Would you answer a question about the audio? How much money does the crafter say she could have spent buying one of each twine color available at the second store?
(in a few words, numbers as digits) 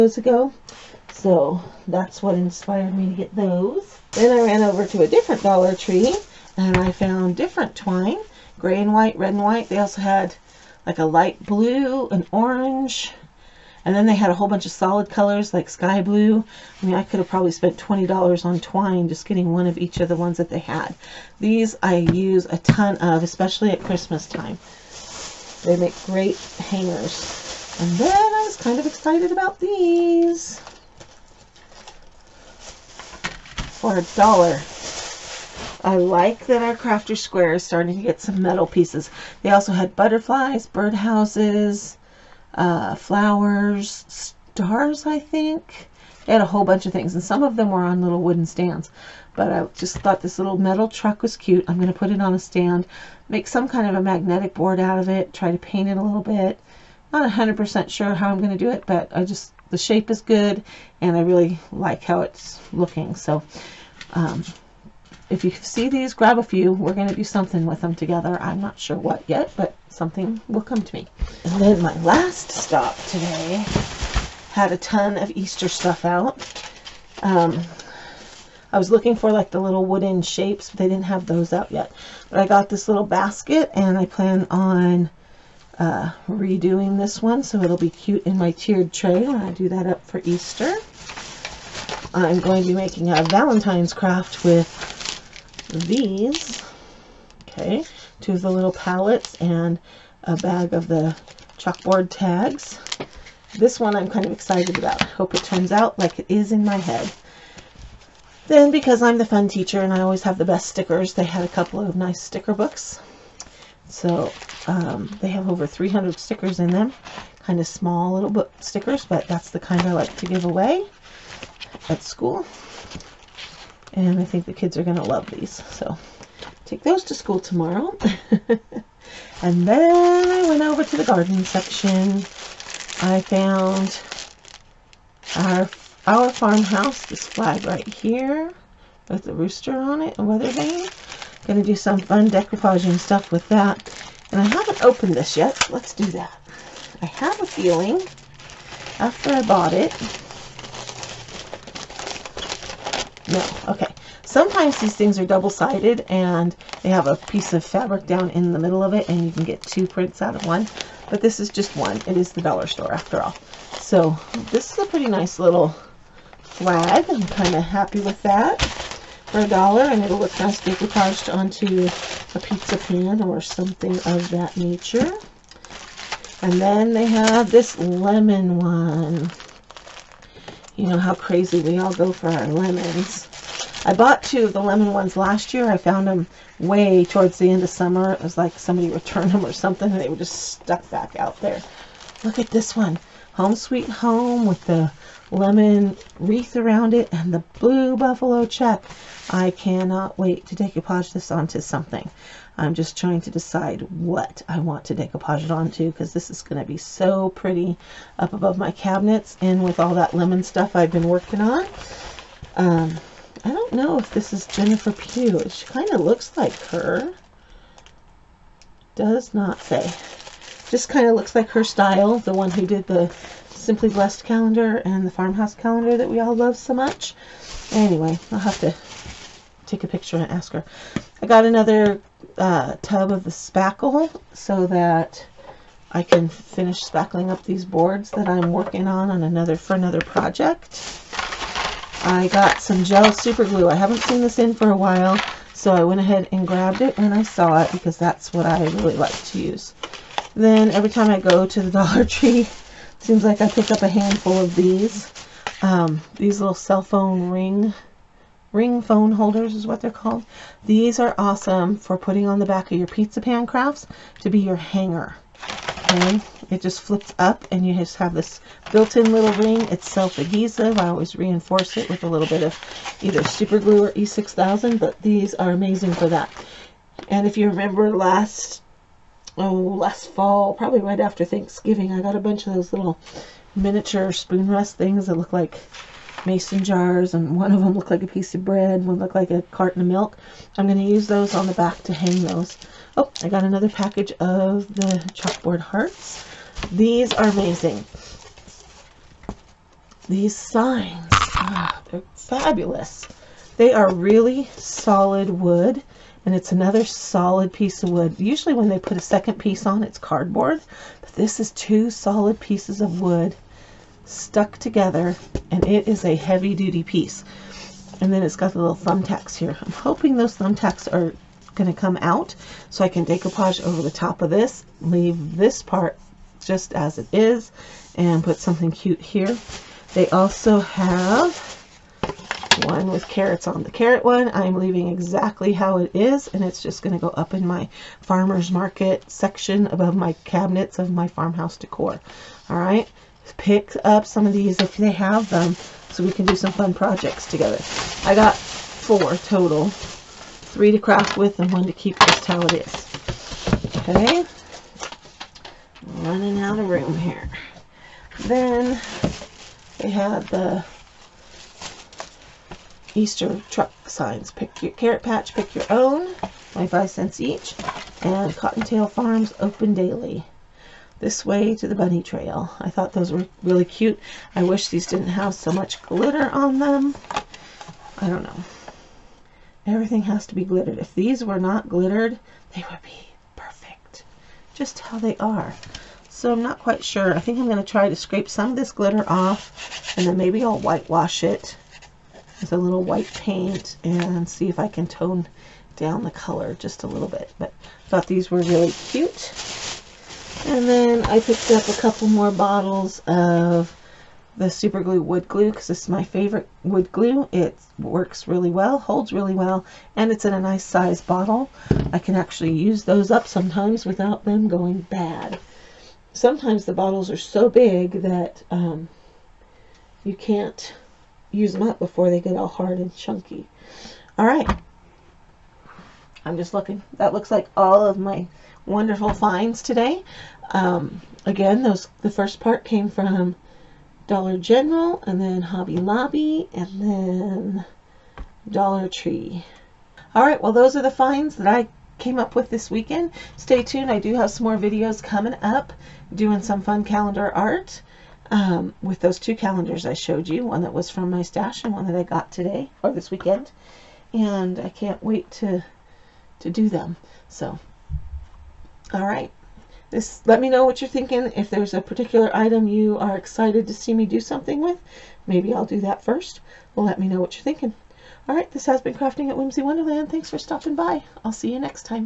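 $20.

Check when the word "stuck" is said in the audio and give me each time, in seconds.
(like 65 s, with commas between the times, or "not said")
190 s, 314 s.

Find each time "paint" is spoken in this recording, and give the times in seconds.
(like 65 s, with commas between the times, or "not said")
55 s, 393 s.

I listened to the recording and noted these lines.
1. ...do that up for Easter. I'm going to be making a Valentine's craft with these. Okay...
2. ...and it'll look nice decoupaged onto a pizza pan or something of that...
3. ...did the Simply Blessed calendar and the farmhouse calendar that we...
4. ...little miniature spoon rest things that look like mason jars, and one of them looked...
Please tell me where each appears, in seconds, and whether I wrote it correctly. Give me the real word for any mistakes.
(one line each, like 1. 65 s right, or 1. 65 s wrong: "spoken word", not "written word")
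1. 89 s right
2. 169 s right
3. 222 s right
4. 282 s right.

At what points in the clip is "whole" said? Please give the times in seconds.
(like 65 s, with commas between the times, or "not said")
14 s, 46 s.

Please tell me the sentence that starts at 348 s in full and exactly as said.
I got four total, three to craft with and one to keep just how it is.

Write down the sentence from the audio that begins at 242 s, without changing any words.
I got some gel super glue.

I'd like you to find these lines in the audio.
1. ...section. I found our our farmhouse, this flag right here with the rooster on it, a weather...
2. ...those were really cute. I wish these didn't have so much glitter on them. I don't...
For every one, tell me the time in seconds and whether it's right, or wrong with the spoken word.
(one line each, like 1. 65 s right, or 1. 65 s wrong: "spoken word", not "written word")
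1. 131 s right
2. 372 s right.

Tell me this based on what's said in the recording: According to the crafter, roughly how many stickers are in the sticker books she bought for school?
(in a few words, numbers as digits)
Over 300.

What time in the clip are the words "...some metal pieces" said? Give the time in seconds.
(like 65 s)
38 s.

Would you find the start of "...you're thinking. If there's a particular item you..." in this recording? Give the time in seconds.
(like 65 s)
460 s.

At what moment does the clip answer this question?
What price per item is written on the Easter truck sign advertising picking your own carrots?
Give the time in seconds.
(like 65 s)
366 s.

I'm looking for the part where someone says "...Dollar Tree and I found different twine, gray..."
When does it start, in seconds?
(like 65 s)
5 s.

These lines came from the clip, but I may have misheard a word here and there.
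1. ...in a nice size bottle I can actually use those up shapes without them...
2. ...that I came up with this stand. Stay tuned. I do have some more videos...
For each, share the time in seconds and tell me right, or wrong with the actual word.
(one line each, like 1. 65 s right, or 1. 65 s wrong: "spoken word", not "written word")
1. 410 s wrong: "sometimes", not "shapes"
2. 441 s wrong: "weekend", not "stand".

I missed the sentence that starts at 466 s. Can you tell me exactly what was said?
Well, let me know what you're thinking.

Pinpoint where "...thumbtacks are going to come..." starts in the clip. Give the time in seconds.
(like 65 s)
320 s.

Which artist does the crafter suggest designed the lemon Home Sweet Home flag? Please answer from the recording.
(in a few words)
Jennifer Pugh.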